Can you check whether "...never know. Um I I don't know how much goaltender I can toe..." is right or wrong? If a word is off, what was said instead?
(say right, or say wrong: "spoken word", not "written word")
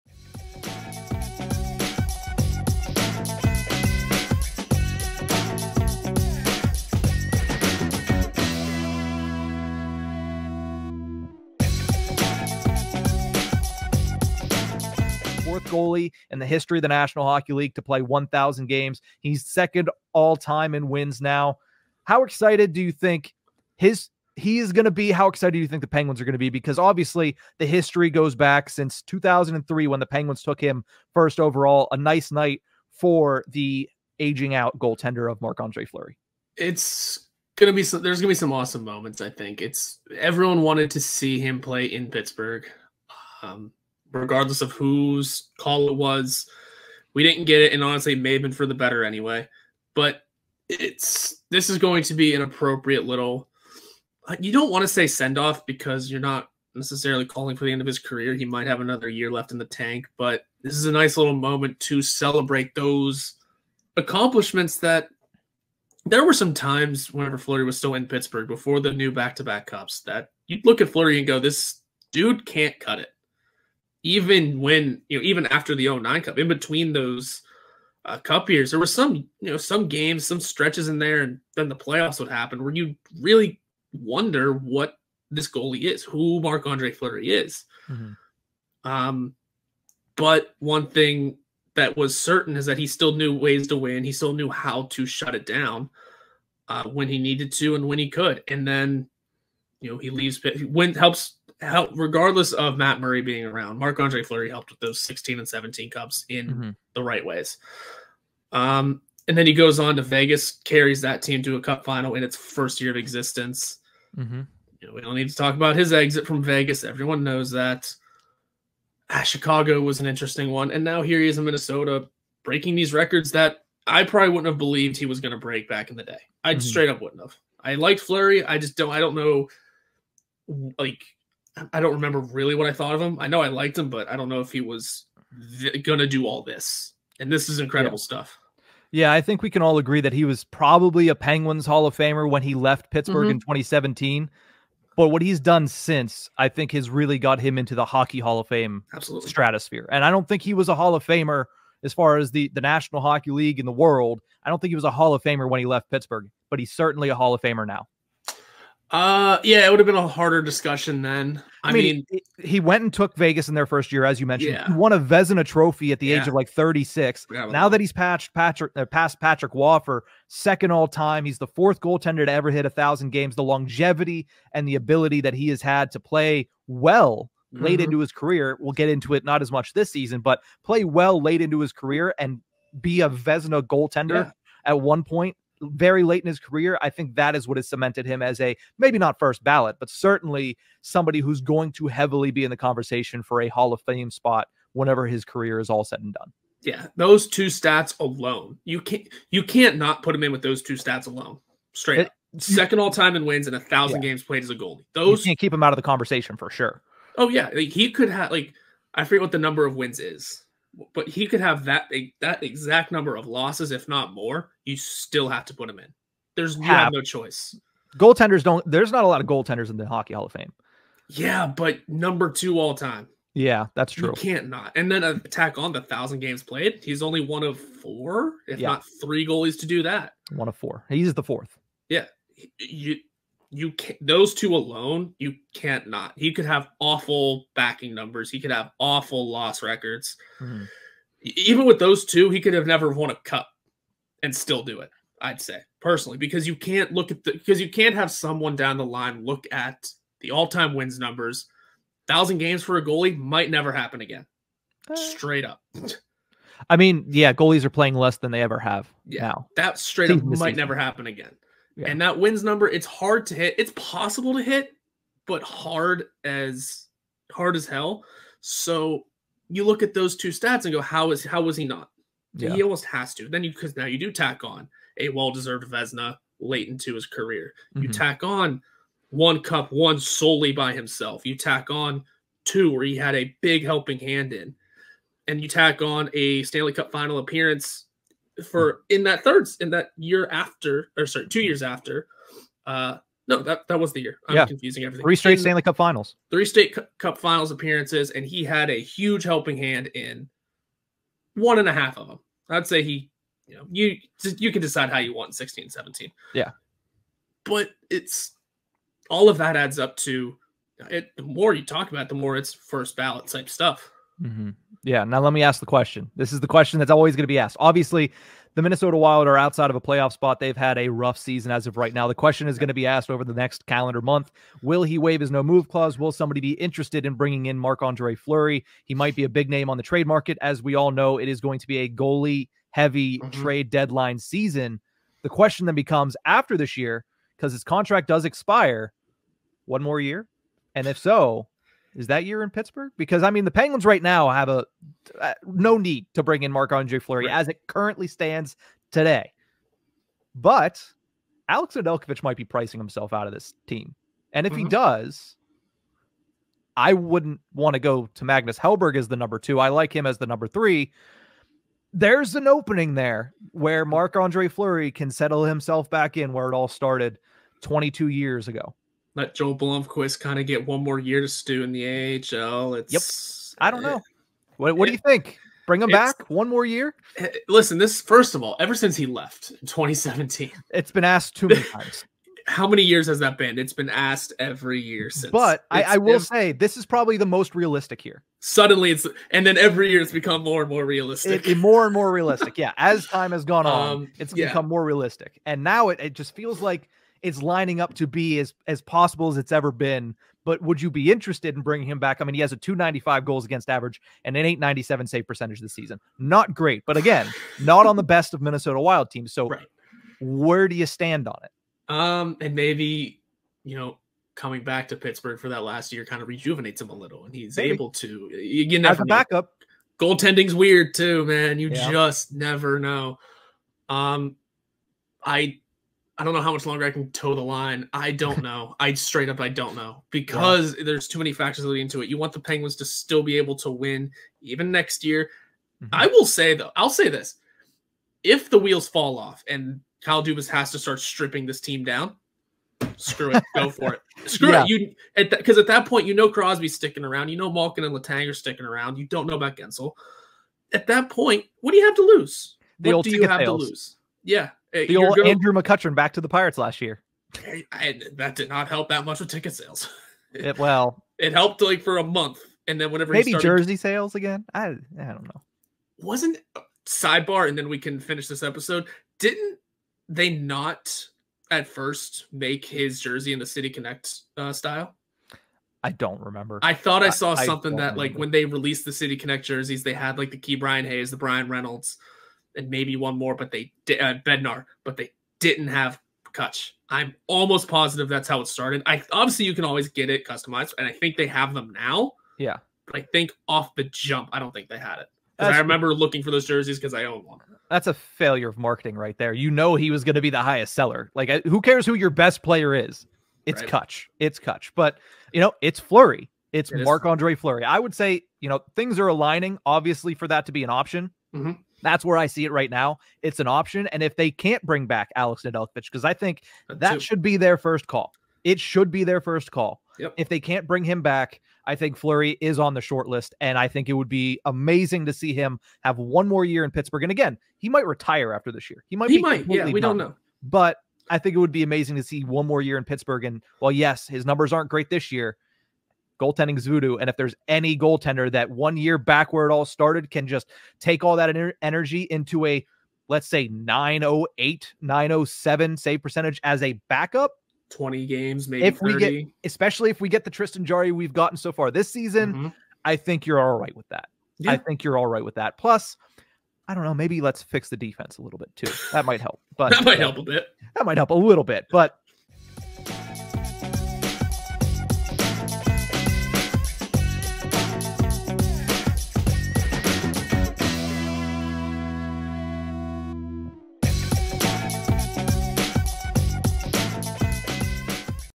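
wrong: "longer", not "goaltender".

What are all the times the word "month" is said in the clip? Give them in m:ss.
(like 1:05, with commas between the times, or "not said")
5:24, 7:42.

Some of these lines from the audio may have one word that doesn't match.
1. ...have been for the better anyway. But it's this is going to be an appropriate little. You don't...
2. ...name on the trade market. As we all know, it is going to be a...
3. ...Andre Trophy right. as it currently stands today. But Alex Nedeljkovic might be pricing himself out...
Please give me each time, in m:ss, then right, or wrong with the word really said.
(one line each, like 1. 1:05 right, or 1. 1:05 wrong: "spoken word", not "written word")
1. 0:48 right
2. 5:29 right
3. 5:46 wrong: "Fleury", not "Trophy".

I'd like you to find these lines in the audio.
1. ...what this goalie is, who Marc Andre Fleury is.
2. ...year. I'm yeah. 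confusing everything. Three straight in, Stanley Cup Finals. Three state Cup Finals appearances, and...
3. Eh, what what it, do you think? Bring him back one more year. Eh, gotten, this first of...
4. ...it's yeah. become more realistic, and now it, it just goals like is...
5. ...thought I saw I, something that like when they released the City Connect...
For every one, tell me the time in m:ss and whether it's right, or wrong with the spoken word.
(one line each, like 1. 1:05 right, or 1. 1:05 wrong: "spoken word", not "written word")
1. 1:24 right
2. 4:54 right
3. 6:13 wrong: "listen", not "gotten"
4. 6:34 wrong: "feels", not "goals"
5. 7:56 right.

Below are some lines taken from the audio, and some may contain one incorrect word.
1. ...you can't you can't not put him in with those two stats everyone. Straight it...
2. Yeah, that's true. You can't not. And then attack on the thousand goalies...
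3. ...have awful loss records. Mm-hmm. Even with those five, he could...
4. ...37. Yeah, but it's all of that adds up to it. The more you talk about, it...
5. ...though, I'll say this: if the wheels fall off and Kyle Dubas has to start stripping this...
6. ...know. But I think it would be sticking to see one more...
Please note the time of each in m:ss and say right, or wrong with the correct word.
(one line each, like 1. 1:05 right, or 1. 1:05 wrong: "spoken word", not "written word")
1. 3:18 wrong: "alone", not "everyone"
2. 3:43 wrong: "games", not "goalies"
3. 3:58 wrong: "two", not "five"
4. 5:05 wrong: "17", not "37"
5. 7:16 right
6. 8:50 wrong: "amazing", not "sticking".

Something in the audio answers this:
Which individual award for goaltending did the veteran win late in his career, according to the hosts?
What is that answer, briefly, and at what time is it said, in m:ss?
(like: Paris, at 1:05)
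Vezina Trophy, at 2:44.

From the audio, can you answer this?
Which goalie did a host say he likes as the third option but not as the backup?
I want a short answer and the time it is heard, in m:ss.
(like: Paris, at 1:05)
Magnus Hellberg, at 5:58.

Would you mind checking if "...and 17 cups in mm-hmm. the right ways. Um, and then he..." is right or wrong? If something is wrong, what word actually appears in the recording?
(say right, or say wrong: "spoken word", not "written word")
right.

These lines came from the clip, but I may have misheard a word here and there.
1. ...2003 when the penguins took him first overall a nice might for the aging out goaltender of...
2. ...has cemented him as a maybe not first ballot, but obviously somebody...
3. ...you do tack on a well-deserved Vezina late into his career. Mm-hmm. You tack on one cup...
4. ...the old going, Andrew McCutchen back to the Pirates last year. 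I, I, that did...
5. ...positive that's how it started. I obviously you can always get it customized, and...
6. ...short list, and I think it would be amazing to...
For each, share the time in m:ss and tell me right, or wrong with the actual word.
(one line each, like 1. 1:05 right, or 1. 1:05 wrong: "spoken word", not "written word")
1. 0:29 wrong: "night", not "might"
2. 3:07 wrong: "certainly", not "obviously"
3. 4:33 right
4. 7:34 right
5. 8:07 right
6. 8:42 right.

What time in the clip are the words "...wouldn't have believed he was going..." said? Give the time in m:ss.
2:04.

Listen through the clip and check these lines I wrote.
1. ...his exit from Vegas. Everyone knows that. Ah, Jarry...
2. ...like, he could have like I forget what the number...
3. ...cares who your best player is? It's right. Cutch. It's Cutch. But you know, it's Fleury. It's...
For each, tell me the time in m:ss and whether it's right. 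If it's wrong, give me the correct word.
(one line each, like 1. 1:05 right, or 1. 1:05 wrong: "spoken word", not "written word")
1. 1:55 wrong: "Chicago", not "Jarry"
2. 3:27 right
3. 8:21 right.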